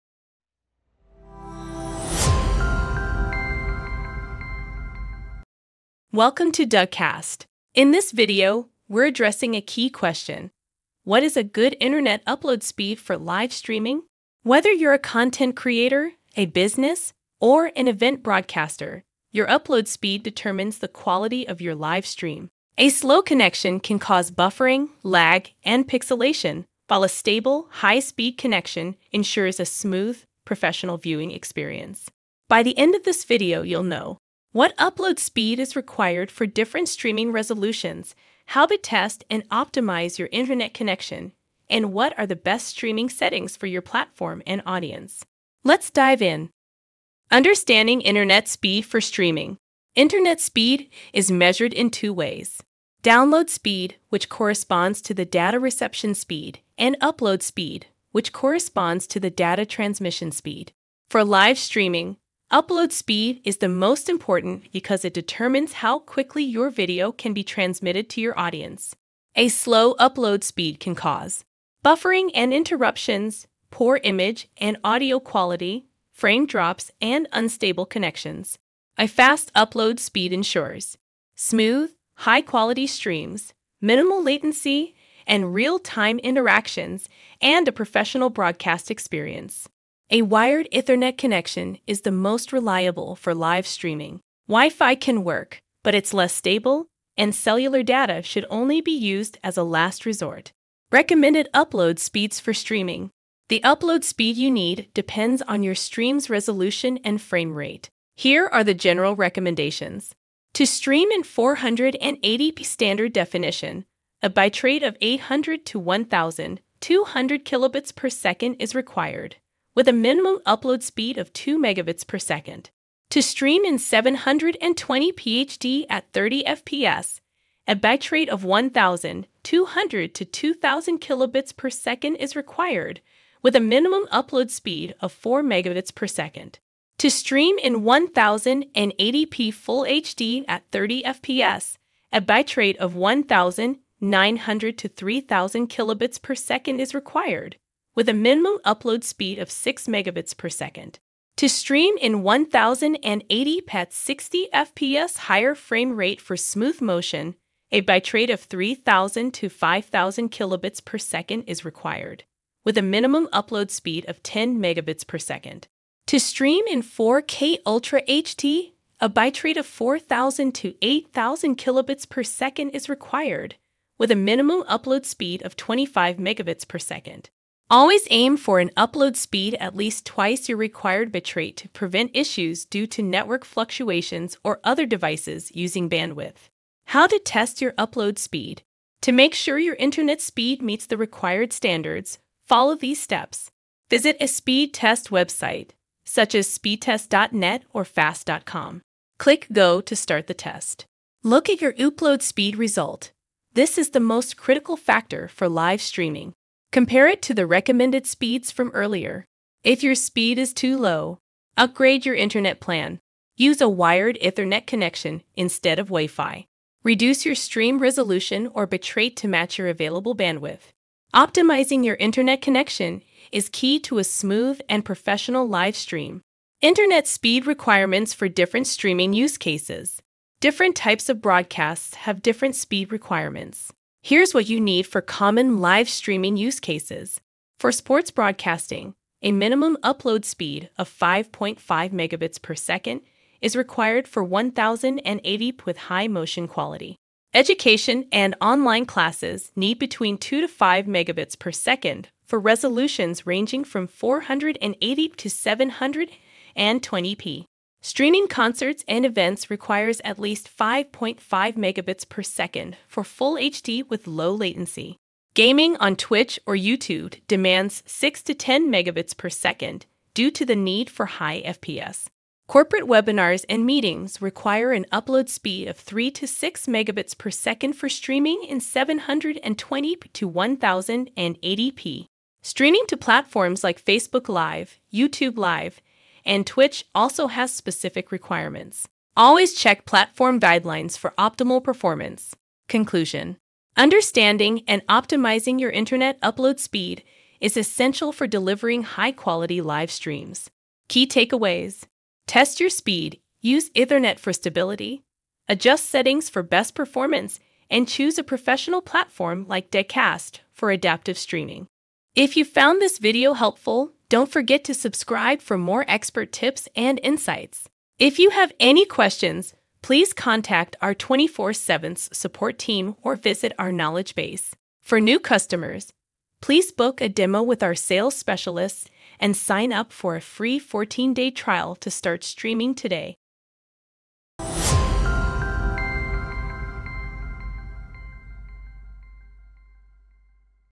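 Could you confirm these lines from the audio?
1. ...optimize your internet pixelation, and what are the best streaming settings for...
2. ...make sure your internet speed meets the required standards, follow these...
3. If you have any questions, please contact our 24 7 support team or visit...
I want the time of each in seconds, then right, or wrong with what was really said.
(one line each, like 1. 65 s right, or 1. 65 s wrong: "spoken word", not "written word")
1. 39 s wrong: "connection", not "pixelation"
2. 189 s right
3. 317 s right.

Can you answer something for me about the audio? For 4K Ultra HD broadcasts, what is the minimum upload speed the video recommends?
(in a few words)
25 megabits per second.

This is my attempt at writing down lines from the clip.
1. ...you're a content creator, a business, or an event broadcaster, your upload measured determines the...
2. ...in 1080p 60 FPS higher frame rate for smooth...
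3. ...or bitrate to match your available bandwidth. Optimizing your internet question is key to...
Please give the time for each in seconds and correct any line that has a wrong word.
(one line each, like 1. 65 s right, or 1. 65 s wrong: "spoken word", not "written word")
1. 14 s wrong: "speed", not "measured"
2. 151 s right
3. 218 s wrong: "connection", not "question".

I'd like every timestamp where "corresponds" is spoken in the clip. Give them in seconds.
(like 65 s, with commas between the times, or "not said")
54 s, 58 s.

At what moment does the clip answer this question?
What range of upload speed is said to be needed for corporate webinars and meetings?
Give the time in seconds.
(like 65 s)
275 s.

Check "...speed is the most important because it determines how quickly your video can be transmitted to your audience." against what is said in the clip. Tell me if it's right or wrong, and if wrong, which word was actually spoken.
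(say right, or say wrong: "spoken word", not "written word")
right.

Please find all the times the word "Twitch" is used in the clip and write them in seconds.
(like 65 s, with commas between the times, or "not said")
265 s, 286 s.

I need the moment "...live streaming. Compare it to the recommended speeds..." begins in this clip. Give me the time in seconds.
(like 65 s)
205 s.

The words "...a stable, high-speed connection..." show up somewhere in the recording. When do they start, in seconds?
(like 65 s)
27 s.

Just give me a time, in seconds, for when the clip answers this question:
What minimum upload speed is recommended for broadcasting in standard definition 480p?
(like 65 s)
121 s.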